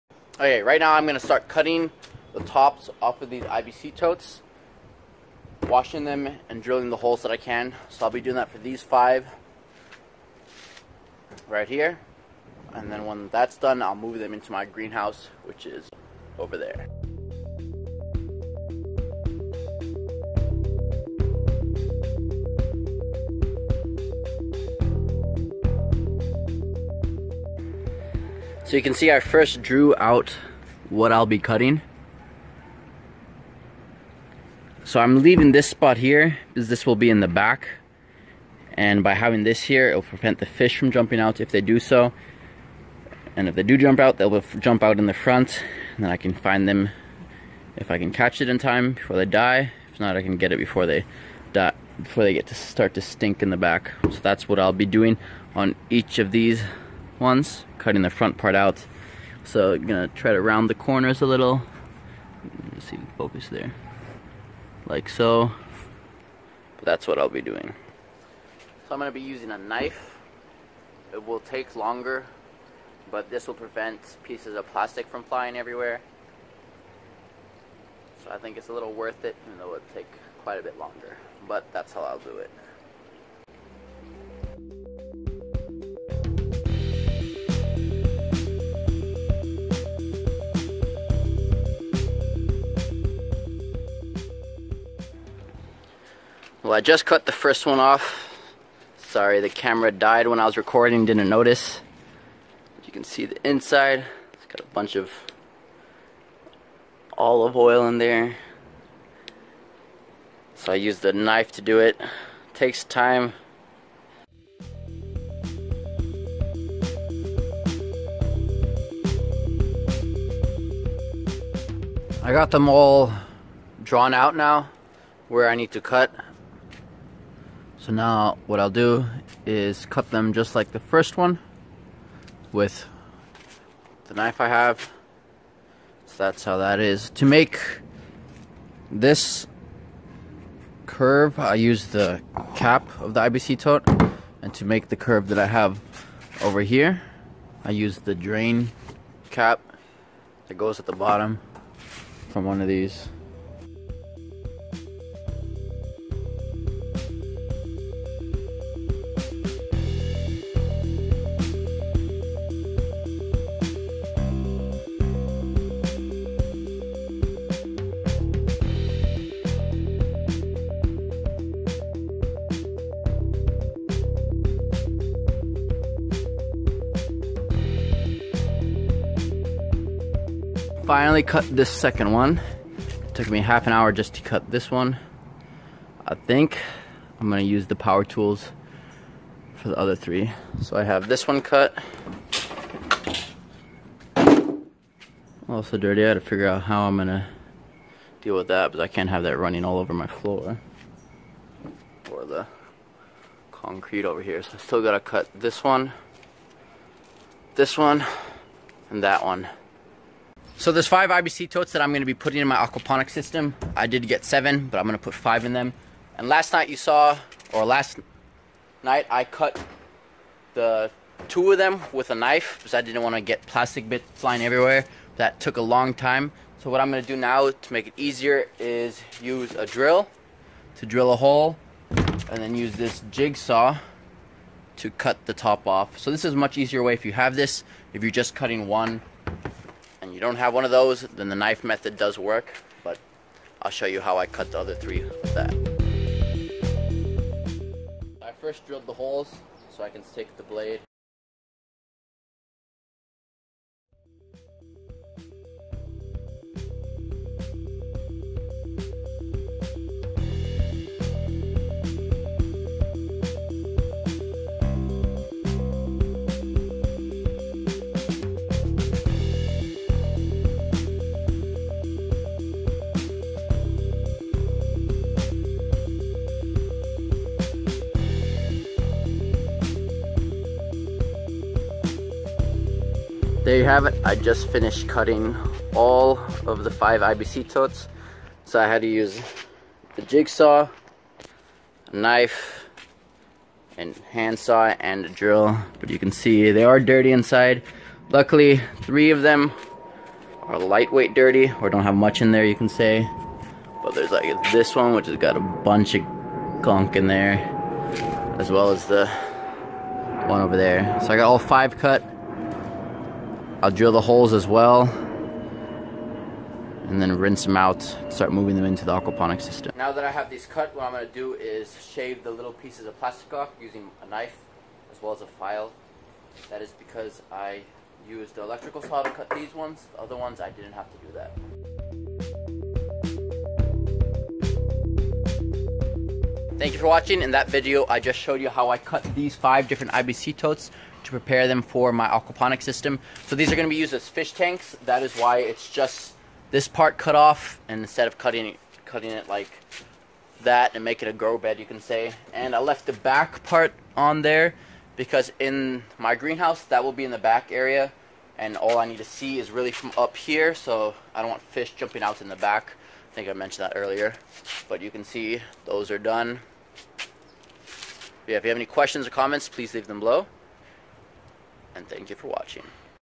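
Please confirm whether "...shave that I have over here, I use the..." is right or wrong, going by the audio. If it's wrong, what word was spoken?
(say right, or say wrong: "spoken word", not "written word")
wrong: "curve", not "shave".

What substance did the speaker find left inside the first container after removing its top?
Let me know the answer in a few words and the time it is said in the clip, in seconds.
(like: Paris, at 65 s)
olive oil, at 107 s.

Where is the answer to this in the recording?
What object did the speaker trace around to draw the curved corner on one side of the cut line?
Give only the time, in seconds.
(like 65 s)
141 s.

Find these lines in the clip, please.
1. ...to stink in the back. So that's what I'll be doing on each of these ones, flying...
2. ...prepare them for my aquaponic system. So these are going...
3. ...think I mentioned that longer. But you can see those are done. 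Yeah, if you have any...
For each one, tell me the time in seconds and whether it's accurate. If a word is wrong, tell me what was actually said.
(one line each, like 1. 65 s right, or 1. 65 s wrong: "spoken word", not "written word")
1. 52 s wrong: "cutting", not "flying"
2. 341 s right
3. 363 s wrong: "earlier", not "longer".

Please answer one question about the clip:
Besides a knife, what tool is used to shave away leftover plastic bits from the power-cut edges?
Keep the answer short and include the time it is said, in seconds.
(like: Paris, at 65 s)
a file, at 325 s.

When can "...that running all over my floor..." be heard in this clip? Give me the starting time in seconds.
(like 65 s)
199 s.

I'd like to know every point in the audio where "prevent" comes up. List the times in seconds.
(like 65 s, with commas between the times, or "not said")
40 s, 73 s.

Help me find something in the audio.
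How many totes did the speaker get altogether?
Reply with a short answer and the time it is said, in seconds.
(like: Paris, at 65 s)
7, at 214 s.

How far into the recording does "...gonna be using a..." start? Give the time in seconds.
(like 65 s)
68 s.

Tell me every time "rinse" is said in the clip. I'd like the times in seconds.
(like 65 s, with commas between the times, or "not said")
317 s.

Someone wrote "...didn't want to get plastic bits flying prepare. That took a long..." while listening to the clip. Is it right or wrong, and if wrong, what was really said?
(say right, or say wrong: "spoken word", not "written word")
wrong: "everywhere", not "prepare".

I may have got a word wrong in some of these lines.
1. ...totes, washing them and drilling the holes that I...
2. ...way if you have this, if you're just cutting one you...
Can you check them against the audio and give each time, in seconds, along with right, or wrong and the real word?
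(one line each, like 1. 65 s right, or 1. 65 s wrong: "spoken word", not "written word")
1. 3 s right
2. 236 s right.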